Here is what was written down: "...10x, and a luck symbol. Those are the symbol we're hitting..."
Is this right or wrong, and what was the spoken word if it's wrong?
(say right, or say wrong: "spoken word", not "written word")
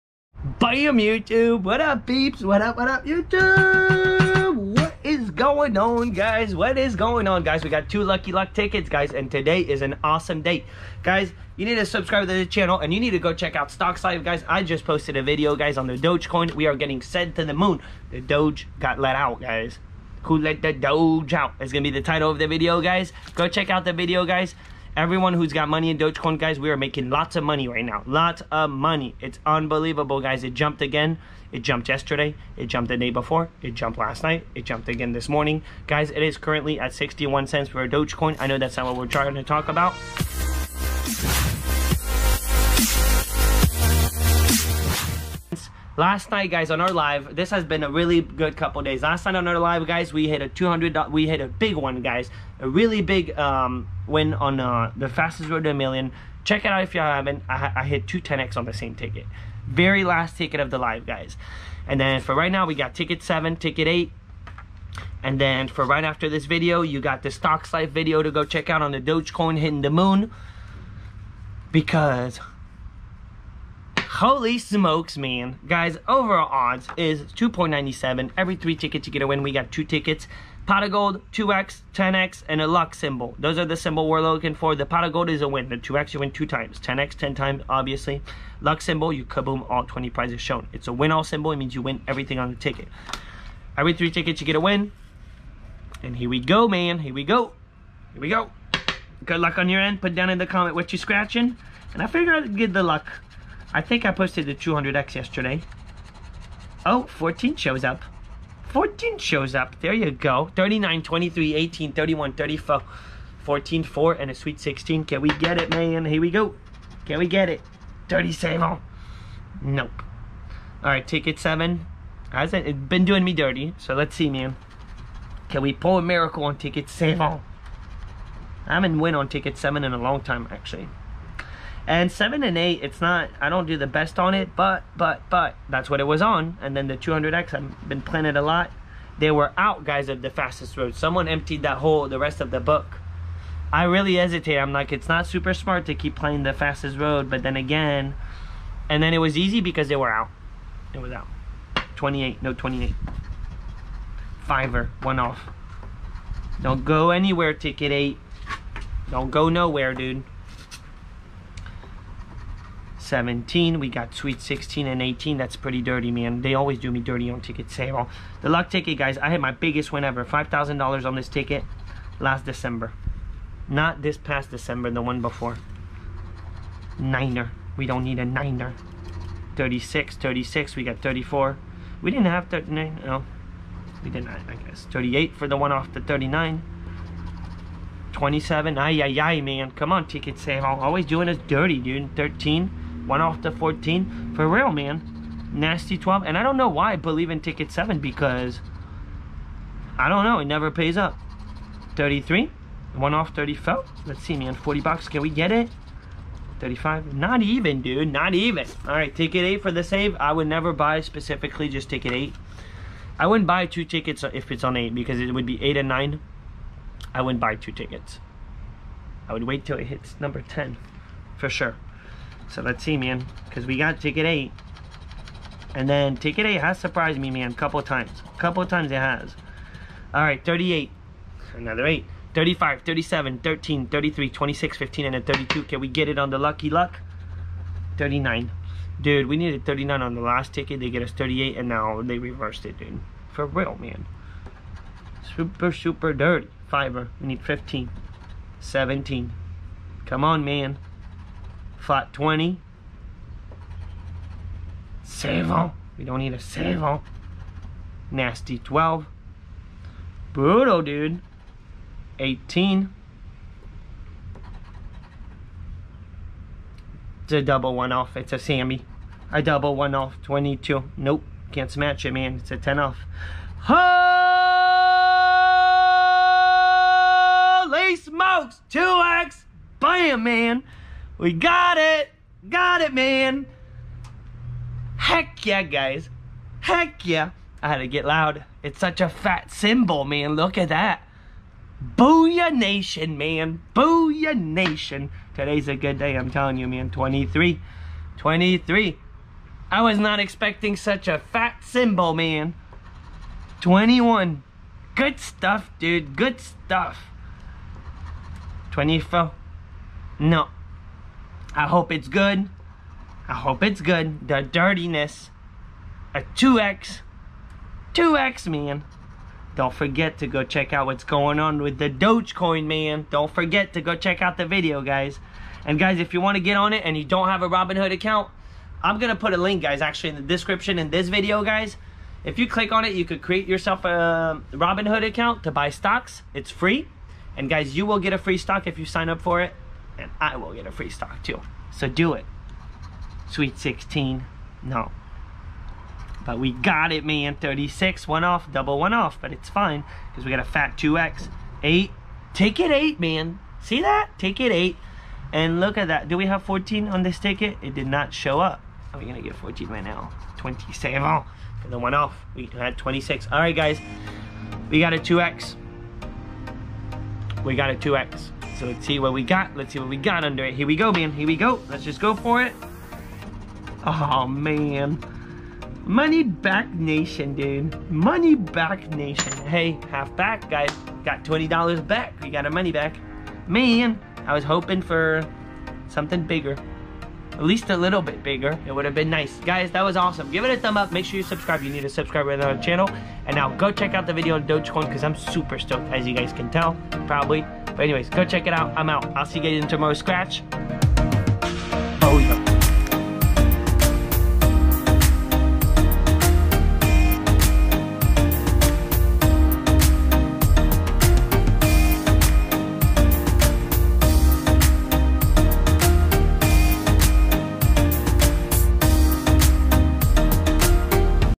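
wrong: "looking", not "hitting".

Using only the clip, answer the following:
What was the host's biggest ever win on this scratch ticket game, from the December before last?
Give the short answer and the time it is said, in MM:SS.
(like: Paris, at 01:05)
$5,000, at 02:50.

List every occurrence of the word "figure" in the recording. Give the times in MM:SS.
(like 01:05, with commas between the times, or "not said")
01:42.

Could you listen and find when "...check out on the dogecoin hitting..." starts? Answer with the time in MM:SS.
01:08.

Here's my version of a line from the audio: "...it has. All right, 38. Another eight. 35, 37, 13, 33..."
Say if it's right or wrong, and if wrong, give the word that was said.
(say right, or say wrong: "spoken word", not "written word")
right.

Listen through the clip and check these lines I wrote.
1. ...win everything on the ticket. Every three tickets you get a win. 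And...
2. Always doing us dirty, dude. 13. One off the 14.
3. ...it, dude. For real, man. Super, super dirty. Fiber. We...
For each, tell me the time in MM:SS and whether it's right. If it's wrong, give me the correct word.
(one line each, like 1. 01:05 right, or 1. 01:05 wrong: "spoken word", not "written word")
1. 01:31 right
2. 03:10 right
3. 04:02 right.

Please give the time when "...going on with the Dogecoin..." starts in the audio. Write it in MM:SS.
05:21.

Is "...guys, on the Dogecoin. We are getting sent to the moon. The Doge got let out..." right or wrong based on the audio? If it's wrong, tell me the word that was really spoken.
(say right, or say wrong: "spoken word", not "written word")
right.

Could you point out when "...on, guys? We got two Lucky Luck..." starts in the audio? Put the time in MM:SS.
00:07.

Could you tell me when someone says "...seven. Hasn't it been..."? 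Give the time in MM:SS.
02:01.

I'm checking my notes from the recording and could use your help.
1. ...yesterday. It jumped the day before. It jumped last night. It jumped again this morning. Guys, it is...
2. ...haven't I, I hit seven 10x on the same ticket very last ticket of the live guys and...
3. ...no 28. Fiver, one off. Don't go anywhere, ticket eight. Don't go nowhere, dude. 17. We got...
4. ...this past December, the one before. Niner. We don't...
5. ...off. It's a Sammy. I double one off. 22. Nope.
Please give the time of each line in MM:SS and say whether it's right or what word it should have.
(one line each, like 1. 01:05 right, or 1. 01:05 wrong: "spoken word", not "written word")
1. 00:31 right
2. 00:56 wrong: "two", not "seven"
3. 02:32 right
4. 02:54 right
5. 04:27 right.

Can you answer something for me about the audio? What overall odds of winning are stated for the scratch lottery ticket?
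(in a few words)
2.97.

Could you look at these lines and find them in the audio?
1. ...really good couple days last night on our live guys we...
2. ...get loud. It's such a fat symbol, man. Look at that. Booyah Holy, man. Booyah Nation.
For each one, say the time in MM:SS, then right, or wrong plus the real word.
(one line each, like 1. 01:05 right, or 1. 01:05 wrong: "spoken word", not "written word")
1. 00:47 right
2. 04:47 wrong: "Nation", not "Holy".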